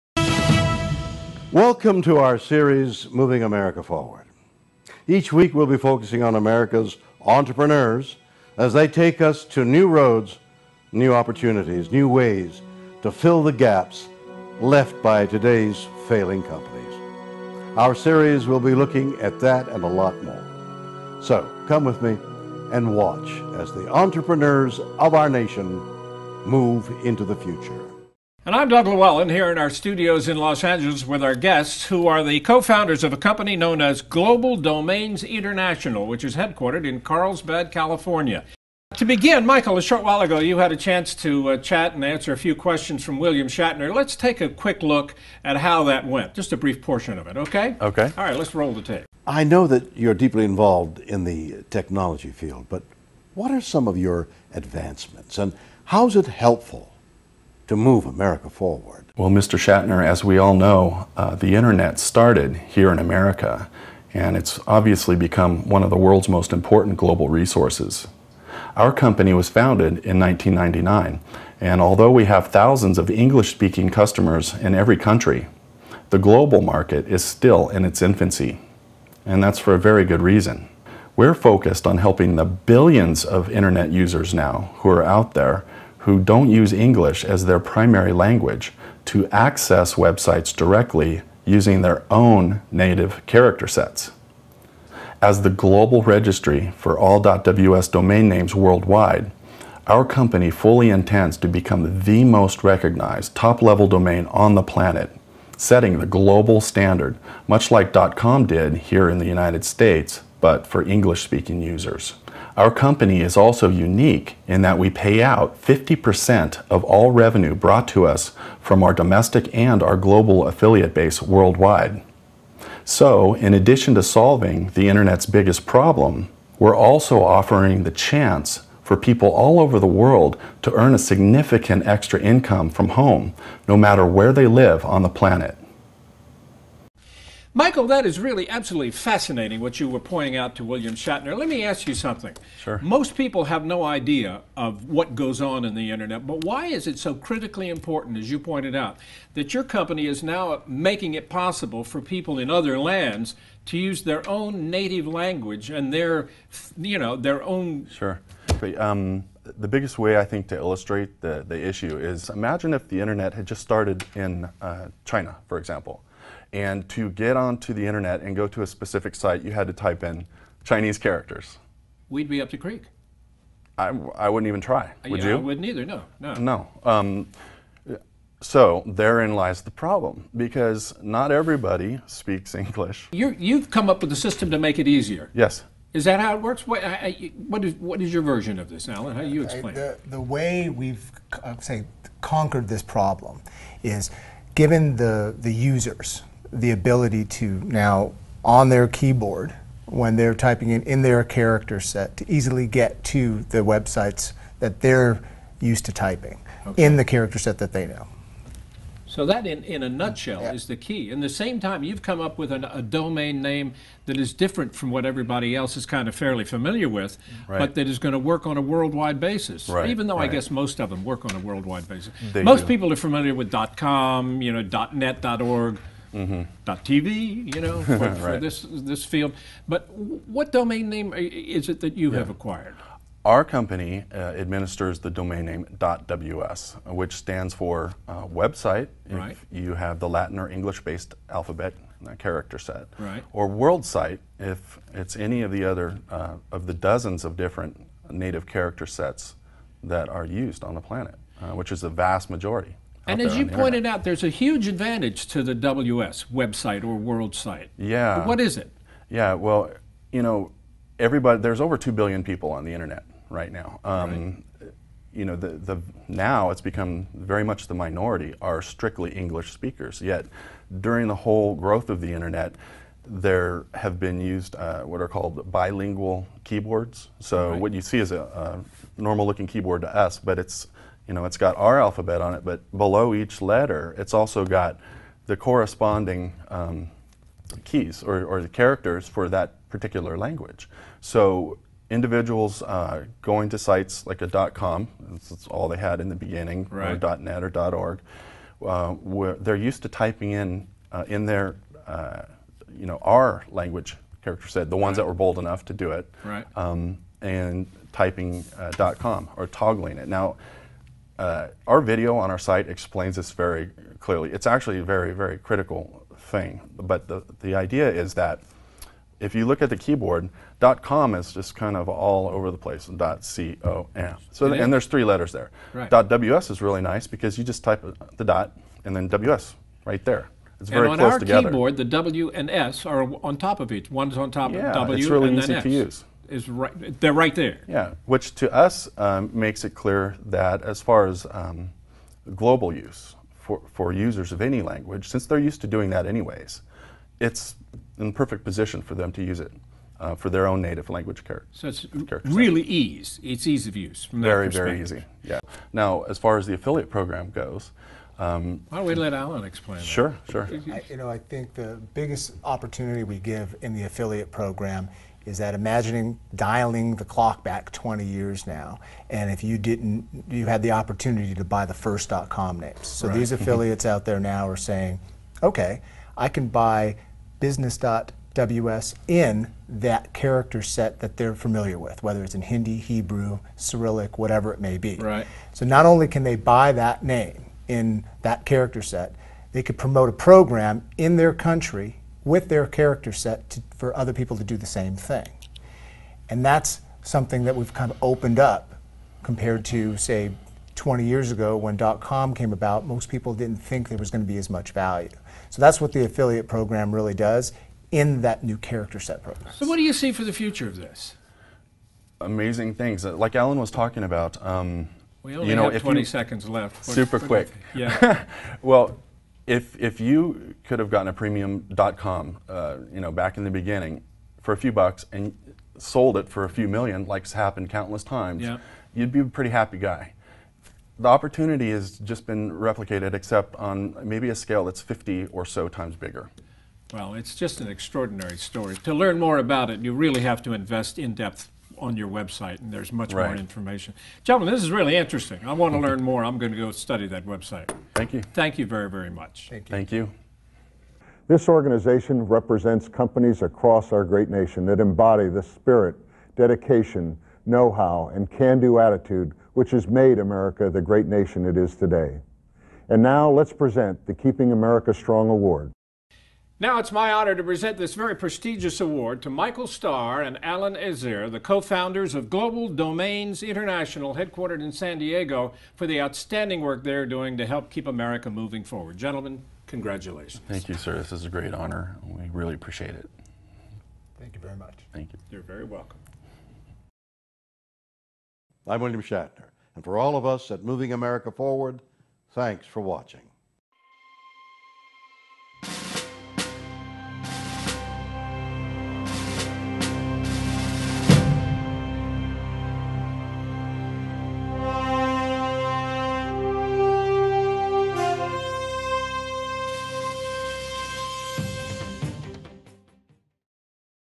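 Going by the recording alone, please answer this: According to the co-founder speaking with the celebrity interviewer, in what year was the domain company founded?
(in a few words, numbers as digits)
1999.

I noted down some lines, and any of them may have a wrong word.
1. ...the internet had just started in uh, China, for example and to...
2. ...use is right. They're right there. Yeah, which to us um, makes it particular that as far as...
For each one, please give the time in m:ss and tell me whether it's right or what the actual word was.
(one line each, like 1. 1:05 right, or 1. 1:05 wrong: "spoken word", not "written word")
1. 2:42 right
2. 5:35 wrong: "clear", not "particular".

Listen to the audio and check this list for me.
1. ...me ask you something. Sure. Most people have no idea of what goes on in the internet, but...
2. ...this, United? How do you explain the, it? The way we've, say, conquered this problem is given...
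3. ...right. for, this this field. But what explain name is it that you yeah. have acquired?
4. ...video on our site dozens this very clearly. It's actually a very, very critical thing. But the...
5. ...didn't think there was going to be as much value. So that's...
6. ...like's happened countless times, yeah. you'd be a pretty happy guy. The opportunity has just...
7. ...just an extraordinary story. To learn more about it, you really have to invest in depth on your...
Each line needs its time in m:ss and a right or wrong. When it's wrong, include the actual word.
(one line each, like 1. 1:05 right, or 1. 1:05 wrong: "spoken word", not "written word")
1. 2:21 right
2. 3:08 wrong: "Alan", not "United"
3. 3:47 wrong: "domain", not "explain"
4. 5:11 wrong: "explains", not "dozens"
5. 6:43 right
6. 7:07 right
7. 7:17 right.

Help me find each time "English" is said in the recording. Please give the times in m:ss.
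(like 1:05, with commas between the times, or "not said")
1:13, 1:26, 1:50, 3:02, 4:00, 4:29.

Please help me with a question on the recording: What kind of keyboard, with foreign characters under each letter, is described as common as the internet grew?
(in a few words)
bilingual keyboards.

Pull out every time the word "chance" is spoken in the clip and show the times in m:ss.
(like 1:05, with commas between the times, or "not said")
0:40, 2:07.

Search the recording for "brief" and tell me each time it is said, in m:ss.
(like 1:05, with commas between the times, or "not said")
0:46.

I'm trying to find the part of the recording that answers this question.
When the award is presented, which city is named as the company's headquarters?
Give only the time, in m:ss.
7:54.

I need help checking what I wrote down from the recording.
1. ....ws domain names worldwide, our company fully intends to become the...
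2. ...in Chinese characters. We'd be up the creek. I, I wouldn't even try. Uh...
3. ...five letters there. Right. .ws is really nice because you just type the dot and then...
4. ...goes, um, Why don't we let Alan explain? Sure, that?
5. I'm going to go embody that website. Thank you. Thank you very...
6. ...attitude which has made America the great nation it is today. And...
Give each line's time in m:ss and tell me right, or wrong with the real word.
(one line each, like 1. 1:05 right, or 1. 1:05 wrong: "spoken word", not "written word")
1. 1:37 right
2. 2:50 right
3. 5:24 wrong: "three", not "five"
4. 5:57 right
5. 7:26 wrong: "study", not "embody"
6. 7:38 right.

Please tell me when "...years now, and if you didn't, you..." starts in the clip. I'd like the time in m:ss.
6:08.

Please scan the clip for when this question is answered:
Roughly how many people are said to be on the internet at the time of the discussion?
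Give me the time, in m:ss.
4:21.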